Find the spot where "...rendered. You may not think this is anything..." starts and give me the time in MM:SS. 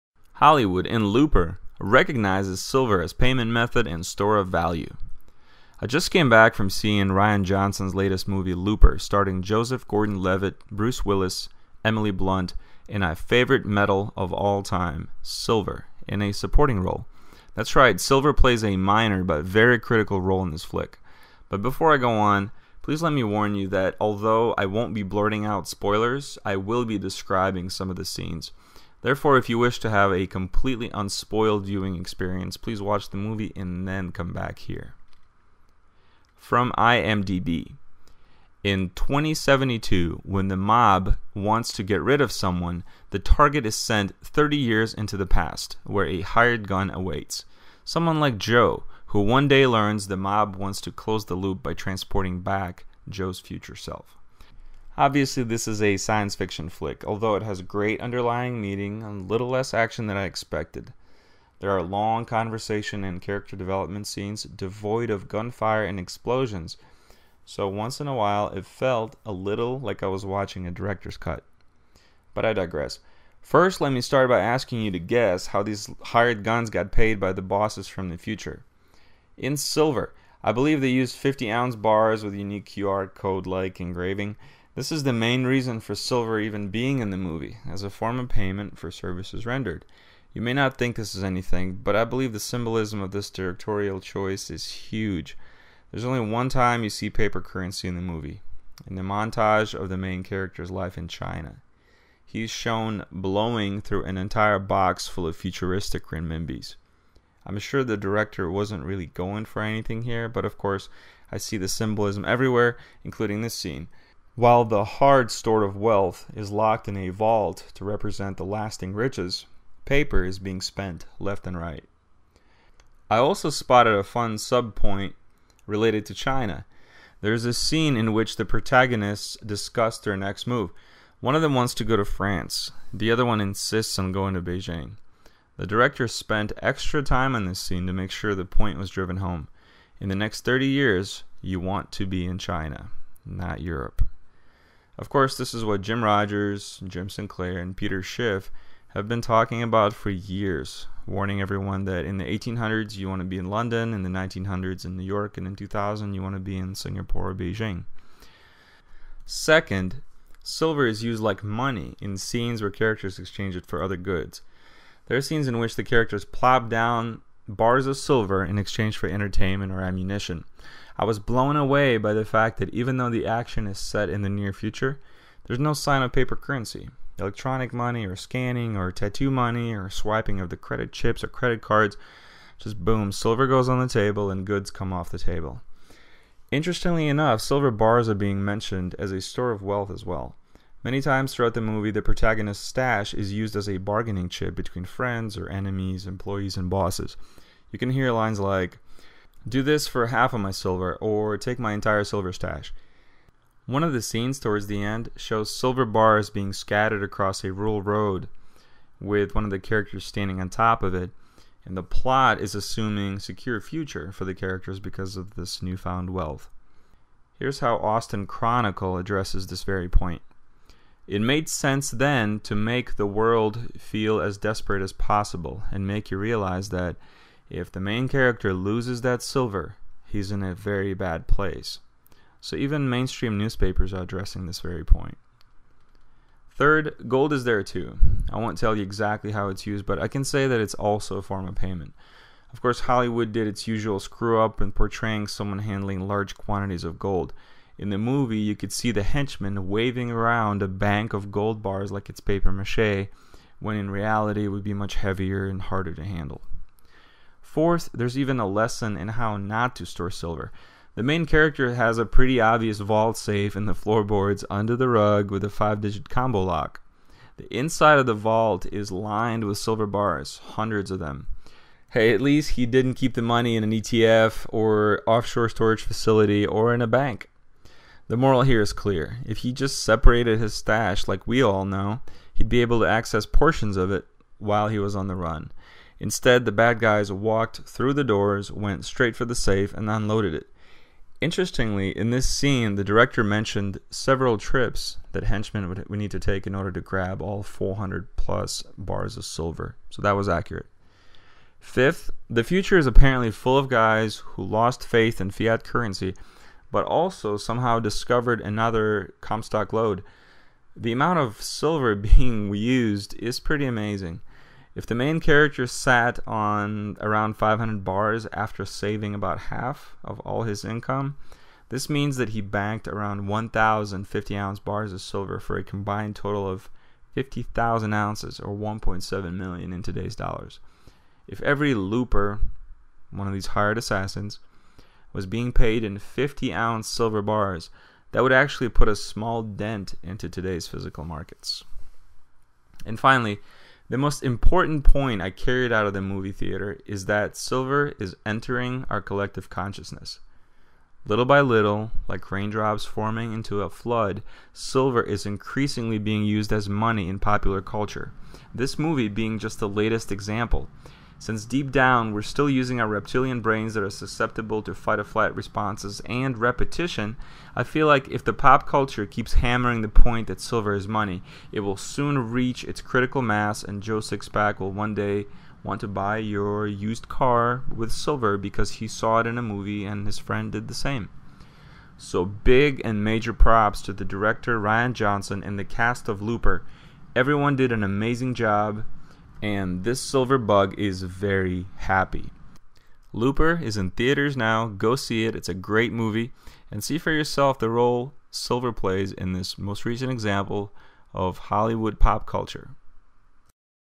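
01:29.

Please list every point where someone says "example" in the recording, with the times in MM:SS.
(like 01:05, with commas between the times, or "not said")
06:00, 06:40.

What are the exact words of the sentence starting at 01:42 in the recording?
He's shown blowing through an entire box full of futuristic renminbis.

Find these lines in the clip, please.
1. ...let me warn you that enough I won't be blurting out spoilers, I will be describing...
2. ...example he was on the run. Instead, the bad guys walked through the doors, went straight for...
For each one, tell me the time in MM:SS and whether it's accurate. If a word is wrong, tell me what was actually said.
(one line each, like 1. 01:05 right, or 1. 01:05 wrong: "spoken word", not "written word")
1. 00:23 wrong: "although", not "enough"
2. 04:44 wrong: "while", not "example".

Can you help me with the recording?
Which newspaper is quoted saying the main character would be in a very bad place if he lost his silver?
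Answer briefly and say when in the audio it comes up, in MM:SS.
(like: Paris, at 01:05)
Austin Chronicle, at 03:37.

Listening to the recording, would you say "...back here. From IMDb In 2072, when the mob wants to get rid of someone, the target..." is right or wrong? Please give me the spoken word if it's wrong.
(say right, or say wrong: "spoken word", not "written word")
right.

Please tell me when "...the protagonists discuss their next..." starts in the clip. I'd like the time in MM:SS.
02:08.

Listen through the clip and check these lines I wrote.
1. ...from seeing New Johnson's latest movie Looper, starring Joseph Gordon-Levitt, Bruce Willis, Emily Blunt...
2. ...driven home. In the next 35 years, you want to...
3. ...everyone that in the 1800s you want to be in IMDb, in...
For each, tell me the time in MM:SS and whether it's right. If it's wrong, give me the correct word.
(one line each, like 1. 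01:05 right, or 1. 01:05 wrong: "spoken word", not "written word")
1. 00:06 wrong: "Rian", not "New"
2. 02:18 wrong: "30", not "35"
3. 02:31 wrong: "London", not "IMDb".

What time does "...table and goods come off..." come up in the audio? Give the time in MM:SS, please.
03:03.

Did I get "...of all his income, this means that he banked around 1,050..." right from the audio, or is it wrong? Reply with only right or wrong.
right.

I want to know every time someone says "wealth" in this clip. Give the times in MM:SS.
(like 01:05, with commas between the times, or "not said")
01:55, 03:09, 03:36.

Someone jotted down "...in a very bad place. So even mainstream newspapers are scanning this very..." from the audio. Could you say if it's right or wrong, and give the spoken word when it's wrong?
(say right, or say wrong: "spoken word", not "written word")
wrong: "addressing", not "scanning".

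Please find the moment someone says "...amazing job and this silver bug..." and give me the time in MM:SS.
06:27.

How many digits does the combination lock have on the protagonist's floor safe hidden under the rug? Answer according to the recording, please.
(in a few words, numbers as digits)
5.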